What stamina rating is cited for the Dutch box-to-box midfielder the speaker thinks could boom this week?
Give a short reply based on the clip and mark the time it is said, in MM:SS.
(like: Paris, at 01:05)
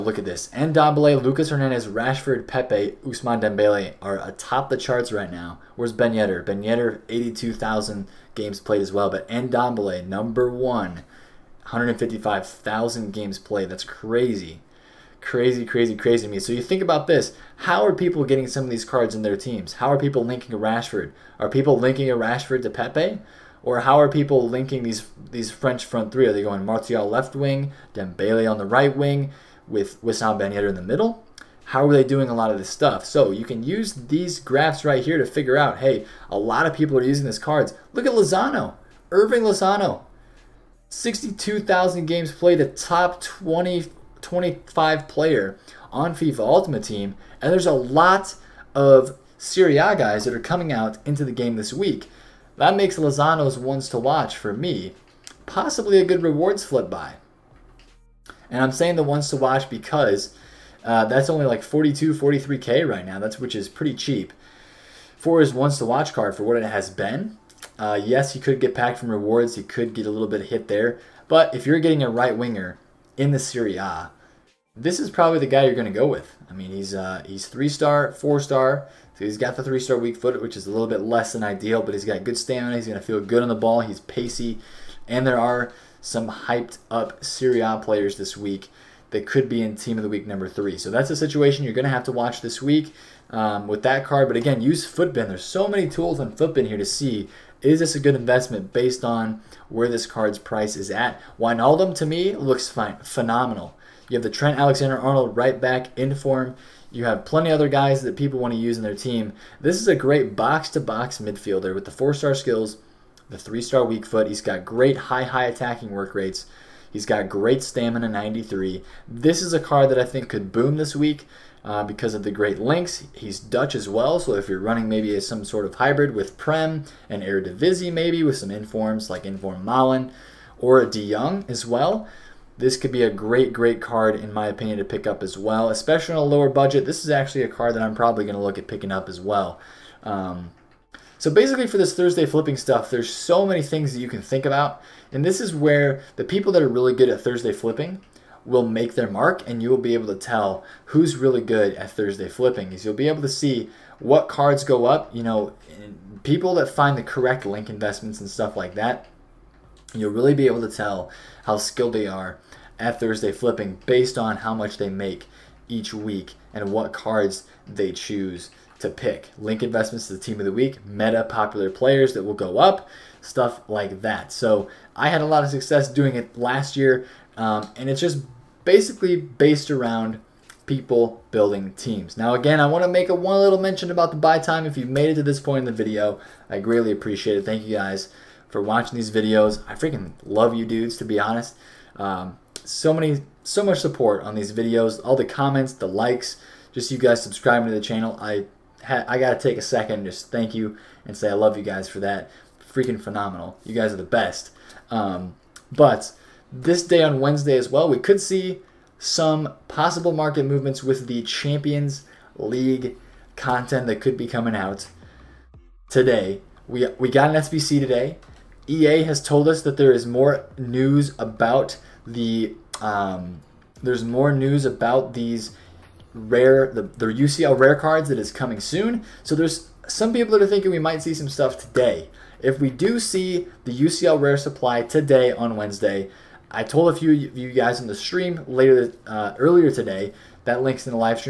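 93, at 01:58.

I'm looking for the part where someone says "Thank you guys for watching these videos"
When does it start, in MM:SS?
03:07.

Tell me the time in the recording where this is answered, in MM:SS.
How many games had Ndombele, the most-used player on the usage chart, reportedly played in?
00:11.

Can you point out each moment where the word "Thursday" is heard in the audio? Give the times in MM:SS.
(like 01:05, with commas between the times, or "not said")
02:21, 02:27, 02:31, 02:42.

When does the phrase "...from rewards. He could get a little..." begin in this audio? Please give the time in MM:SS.
01:08.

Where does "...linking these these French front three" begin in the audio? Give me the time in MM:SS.
00:24.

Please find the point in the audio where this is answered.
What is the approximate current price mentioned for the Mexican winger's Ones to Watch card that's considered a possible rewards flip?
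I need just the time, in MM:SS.
01:01.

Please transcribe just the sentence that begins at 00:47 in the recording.
And there's a lot of Serie A guys that are coming out into the game this week.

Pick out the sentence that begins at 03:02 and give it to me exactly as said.
Now again, I want to make a one little mention about the buy time.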